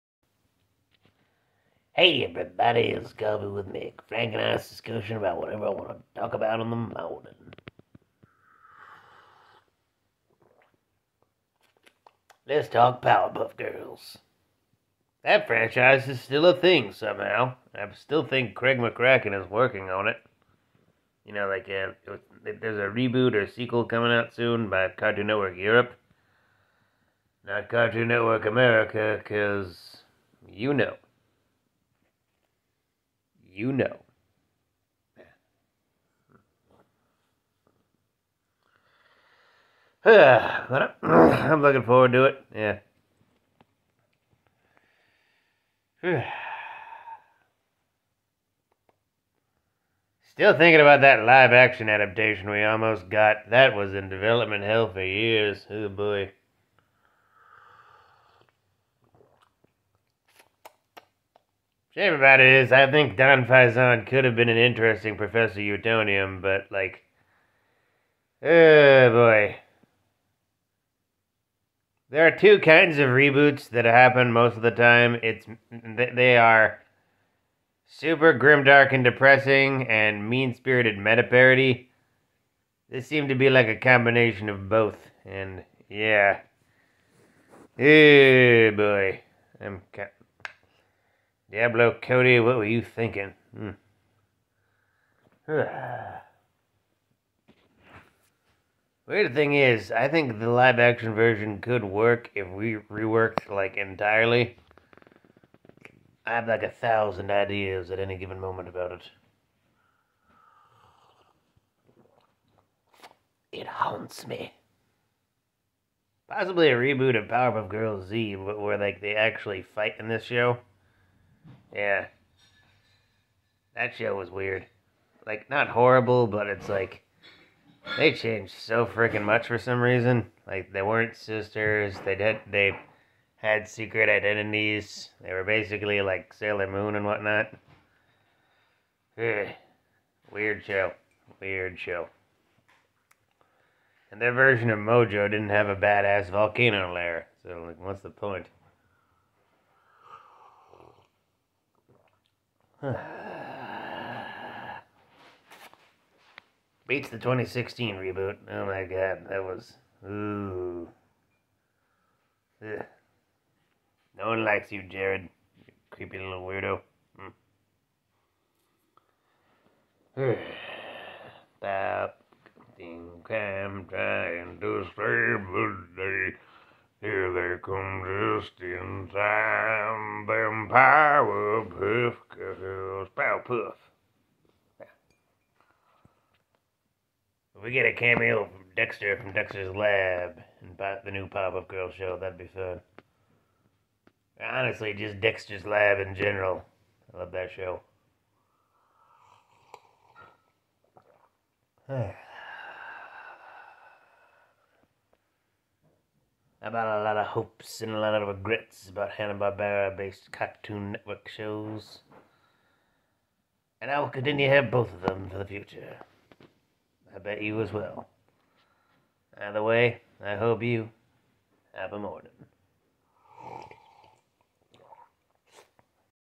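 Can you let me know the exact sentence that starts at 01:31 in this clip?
Diablo Cody, what were you thinking?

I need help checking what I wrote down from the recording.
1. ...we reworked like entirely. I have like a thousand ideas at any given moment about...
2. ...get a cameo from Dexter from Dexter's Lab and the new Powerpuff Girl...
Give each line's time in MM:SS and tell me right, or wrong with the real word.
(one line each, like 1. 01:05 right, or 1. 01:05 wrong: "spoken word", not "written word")
1. 01:42 right
2. 03:07 right.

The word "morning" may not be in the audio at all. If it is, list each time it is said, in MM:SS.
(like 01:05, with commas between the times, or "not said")
00:06, 03:41.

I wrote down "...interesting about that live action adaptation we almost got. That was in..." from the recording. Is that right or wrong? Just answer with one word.
wrong.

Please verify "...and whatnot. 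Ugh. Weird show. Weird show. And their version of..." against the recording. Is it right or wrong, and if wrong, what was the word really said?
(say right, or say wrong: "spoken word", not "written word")
right.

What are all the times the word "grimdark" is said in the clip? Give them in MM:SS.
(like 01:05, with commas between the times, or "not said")
01:18.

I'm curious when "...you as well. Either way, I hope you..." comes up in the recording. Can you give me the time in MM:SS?
03:37.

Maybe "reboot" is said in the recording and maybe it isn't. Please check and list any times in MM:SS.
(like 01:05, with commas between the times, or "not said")
00:22, 01:13, 01:56, 02:37.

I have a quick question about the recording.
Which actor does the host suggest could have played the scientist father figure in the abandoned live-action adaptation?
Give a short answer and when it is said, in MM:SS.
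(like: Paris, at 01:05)
Don Faison, at 01:03.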